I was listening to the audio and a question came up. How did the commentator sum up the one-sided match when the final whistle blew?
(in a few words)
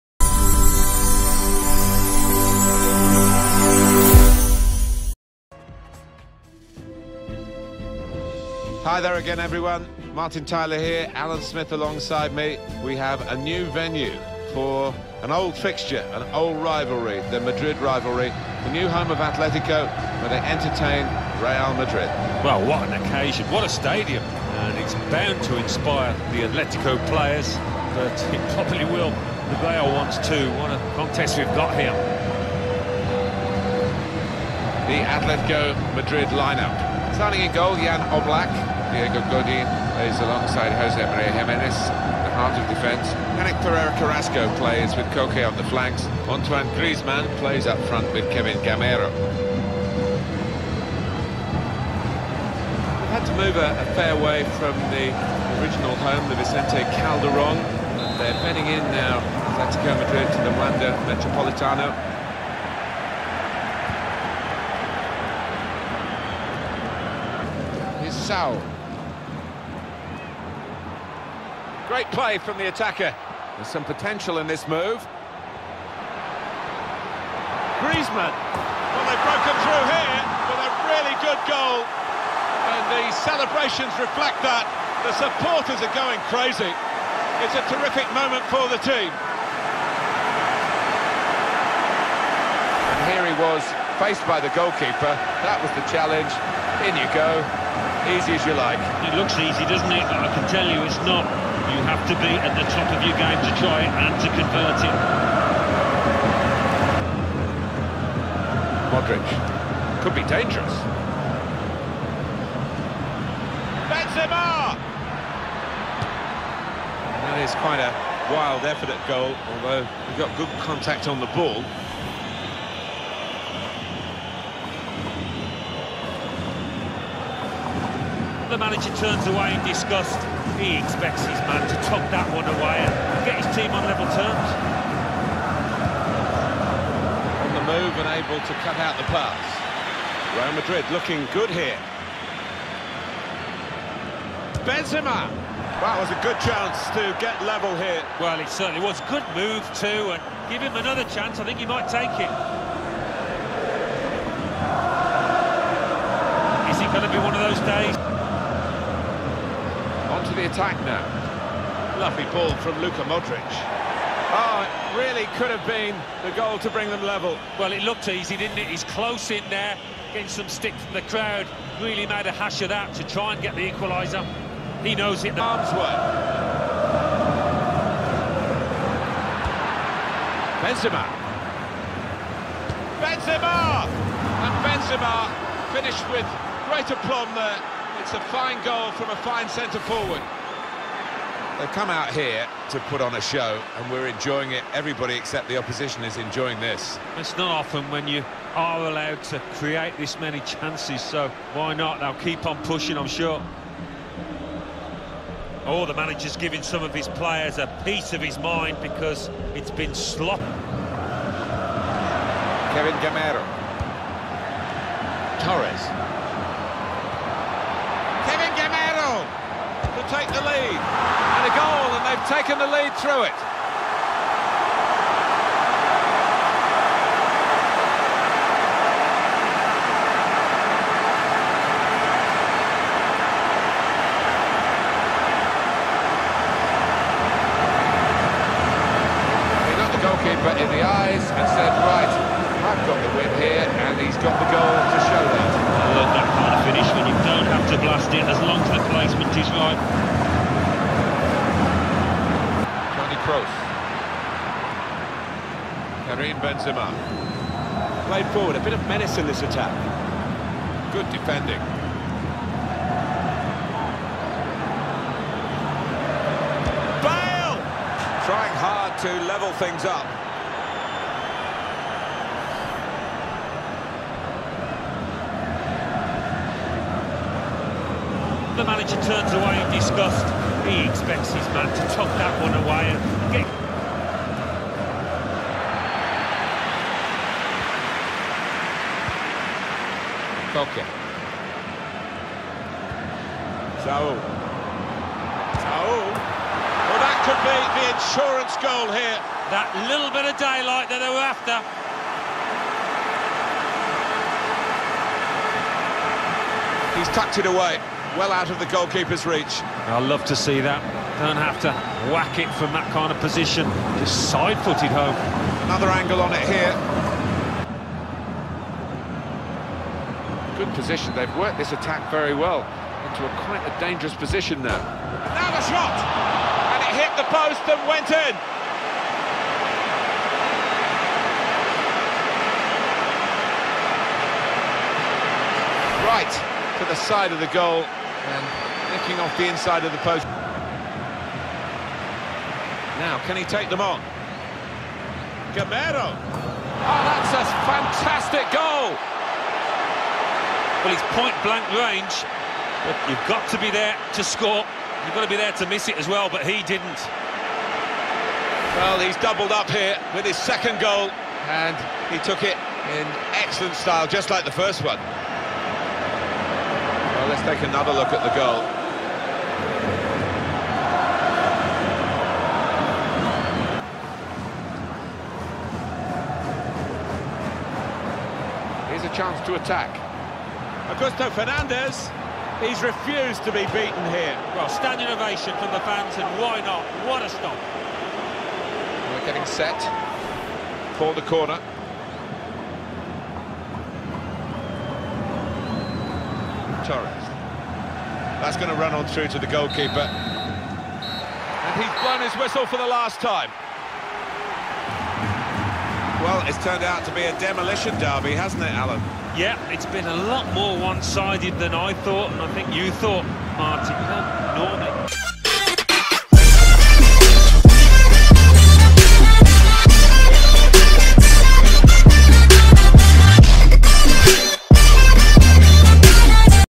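A demolition derby.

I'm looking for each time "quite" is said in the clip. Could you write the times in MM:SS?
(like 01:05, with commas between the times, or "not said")
01:57, 05:23.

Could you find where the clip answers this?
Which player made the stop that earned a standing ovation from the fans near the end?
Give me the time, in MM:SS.
06:20.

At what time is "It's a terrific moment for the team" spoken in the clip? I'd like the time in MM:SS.
01:27.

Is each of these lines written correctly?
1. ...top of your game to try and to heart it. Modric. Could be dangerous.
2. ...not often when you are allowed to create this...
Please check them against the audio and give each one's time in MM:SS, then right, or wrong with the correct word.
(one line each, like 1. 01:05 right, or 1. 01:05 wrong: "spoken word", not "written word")
1. 01:42 wrong: "convert", not "heart"
2. 03:17 right.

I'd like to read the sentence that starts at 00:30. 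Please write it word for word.
What a contest we've got here.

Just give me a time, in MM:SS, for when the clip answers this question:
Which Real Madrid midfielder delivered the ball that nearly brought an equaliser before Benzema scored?
02:42.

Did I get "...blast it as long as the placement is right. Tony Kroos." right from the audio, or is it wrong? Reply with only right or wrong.
right.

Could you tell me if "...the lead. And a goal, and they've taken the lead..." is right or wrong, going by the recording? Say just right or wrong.
right.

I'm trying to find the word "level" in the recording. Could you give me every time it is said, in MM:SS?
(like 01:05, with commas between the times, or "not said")
02:13, 02:27, 02:47, 04:29.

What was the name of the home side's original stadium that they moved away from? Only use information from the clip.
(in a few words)
Vicente Calderon.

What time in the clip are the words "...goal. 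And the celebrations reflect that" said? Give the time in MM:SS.
01:21.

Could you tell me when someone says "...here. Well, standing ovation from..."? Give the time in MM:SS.
06:24.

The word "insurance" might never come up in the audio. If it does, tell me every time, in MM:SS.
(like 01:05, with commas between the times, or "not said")
04:57.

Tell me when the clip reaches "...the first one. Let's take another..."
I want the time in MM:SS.
06:04.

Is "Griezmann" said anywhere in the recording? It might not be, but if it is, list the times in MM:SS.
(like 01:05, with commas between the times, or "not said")
00:46, 01:17.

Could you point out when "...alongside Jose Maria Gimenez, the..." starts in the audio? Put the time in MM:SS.
00:40.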